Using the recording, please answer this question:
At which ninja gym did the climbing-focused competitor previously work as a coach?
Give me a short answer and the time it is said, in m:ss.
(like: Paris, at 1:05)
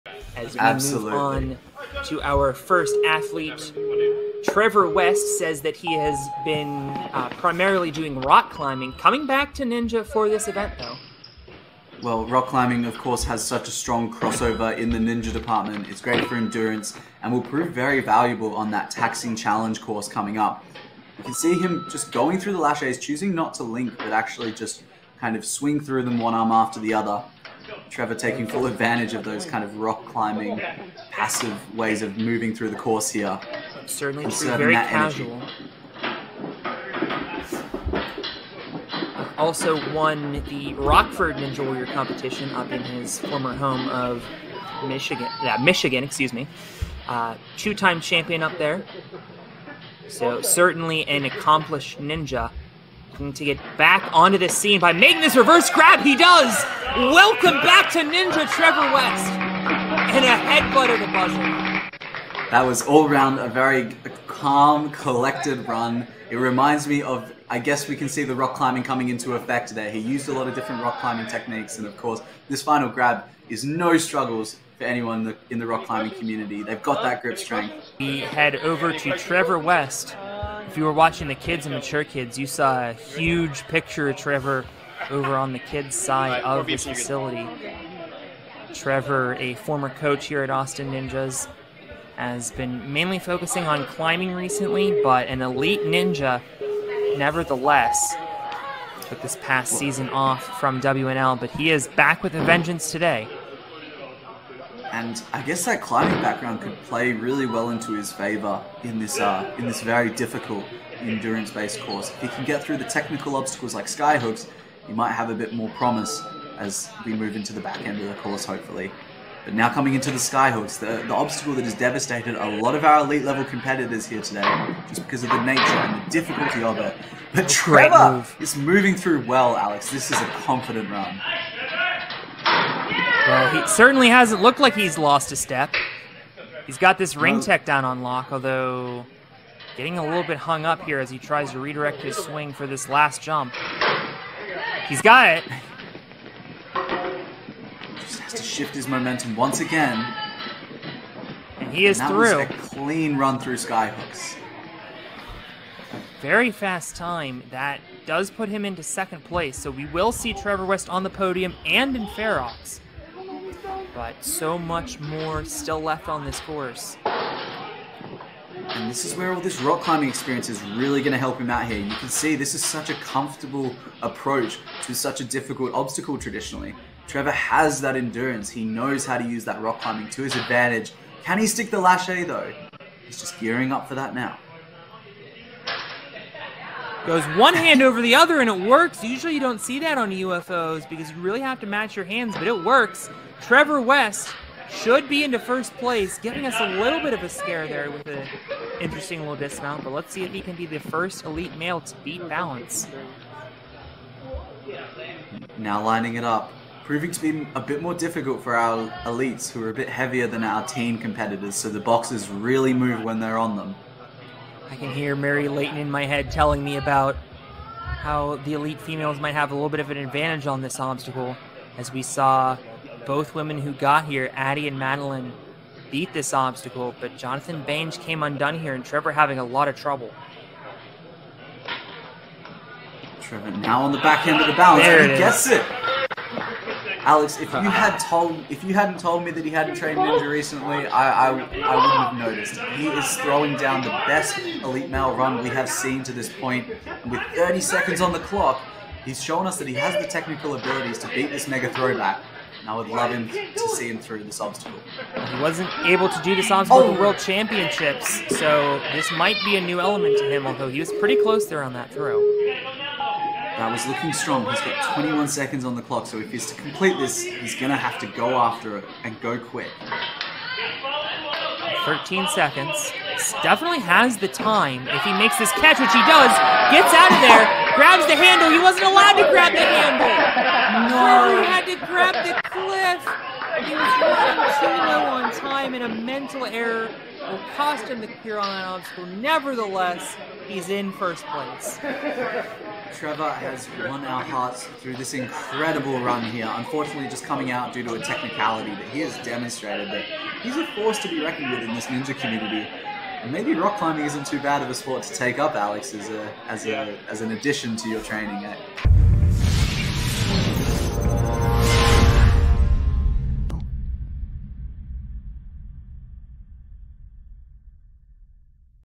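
Austin Ninjas, at 1:30.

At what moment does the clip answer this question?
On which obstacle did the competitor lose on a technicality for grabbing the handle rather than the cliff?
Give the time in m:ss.
4:48.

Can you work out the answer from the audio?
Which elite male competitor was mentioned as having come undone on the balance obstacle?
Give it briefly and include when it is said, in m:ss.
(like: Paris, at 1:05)
Jonathan Bange, at 3:47.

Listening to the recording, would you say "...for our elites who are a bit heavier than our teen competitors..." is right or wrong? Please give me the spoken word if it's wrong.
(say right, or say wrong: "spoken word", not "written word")
right.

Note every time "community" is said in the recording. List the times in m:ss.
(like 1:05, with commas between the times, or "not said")
1:16, 5:02.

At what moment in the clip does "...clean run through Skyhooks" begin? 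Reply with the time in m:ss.
2:32.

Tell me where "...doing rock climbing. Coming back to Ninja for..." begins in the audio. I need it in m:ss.
0:07.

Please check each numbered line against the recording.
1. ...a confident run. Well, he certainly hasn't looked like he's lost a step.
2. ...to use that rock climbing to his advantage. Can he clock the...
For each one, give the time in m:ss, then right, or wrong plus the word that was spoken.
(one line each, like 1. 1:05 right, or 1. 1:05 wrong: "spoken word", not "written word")
1. 2:10 right
2. 2:59 wrong: "stick", not "clock".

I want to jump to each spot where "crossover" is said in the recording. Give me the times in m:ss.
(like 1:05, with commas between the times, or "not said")
0:14.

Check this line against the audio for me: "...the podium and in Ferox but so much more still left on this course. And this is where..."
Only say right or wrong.
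right.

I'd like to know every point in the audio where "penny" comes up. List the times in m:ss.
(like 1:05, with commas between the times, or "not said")
not said.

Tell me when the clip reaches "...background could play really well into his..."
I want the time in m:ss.
1:46.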